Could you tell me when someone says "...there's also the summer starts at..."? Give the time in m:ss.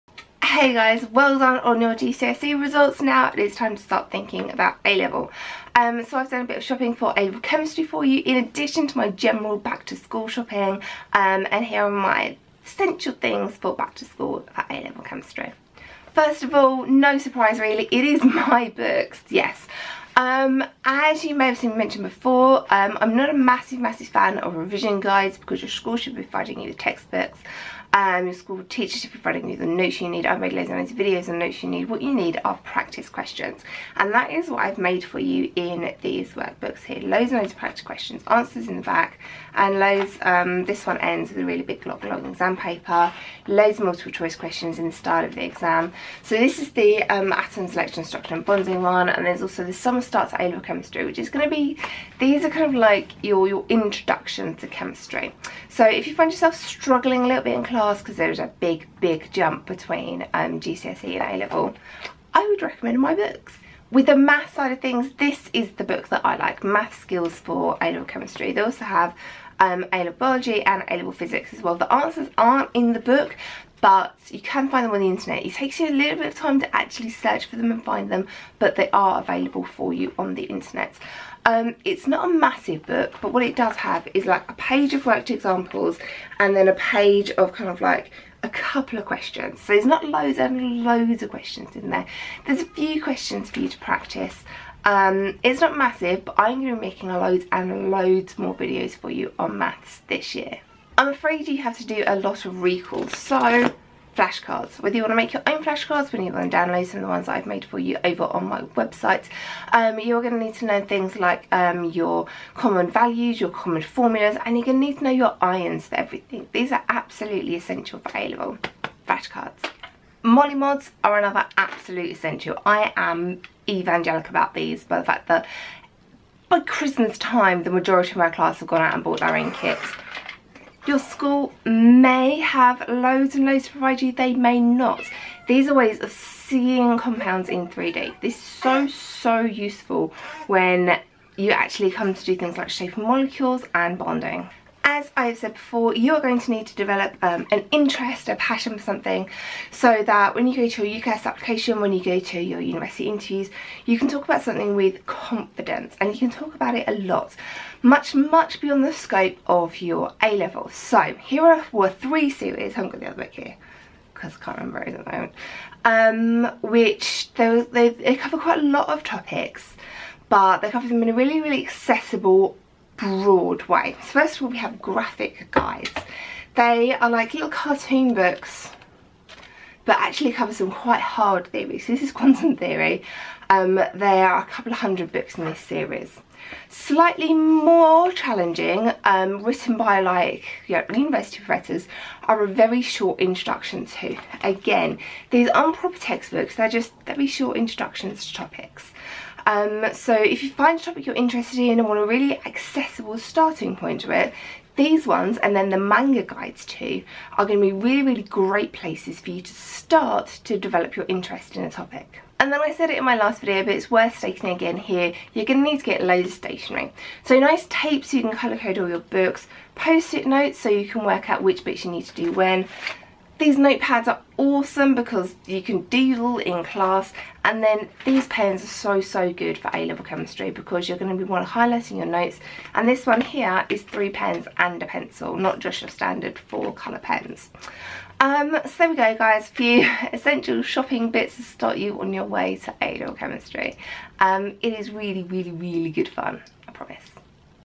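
0:49.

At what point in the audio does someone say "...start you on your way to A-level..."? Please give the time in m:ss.
4:01.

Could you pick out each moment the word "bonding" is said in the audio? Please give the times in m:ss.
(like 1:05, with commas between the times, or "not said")
0:48, 2:23.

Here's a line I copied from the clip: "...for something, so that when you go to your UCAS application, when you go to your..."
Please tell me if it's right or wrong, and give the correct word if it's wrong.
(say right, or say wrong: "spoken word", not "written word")
right.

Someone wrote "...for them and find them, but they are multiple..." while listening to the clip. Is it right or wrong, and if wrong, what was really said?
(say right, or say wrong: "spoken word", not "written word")
wrong: "available", not "multiple".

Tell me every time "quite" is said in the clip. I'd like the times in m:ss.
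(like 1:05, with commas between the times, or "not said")
2:48, 3:00.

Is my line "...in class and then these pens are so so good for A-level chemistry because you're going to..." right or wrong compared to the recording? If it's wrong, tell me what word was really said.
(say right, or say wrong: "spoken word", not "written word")
right.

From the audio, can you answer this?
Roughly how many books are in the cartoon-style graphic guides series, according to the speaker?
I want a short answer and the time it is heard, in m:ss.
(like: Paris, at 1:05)
A couple of hundred, at 3:04.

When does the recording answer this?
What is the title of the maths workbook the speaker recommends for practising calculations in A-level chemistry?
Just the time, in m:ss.
1:06.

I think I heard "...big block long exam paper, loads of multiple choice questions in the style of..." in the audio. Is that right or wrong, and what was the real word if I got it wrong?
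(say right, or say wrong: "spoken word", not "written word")
right.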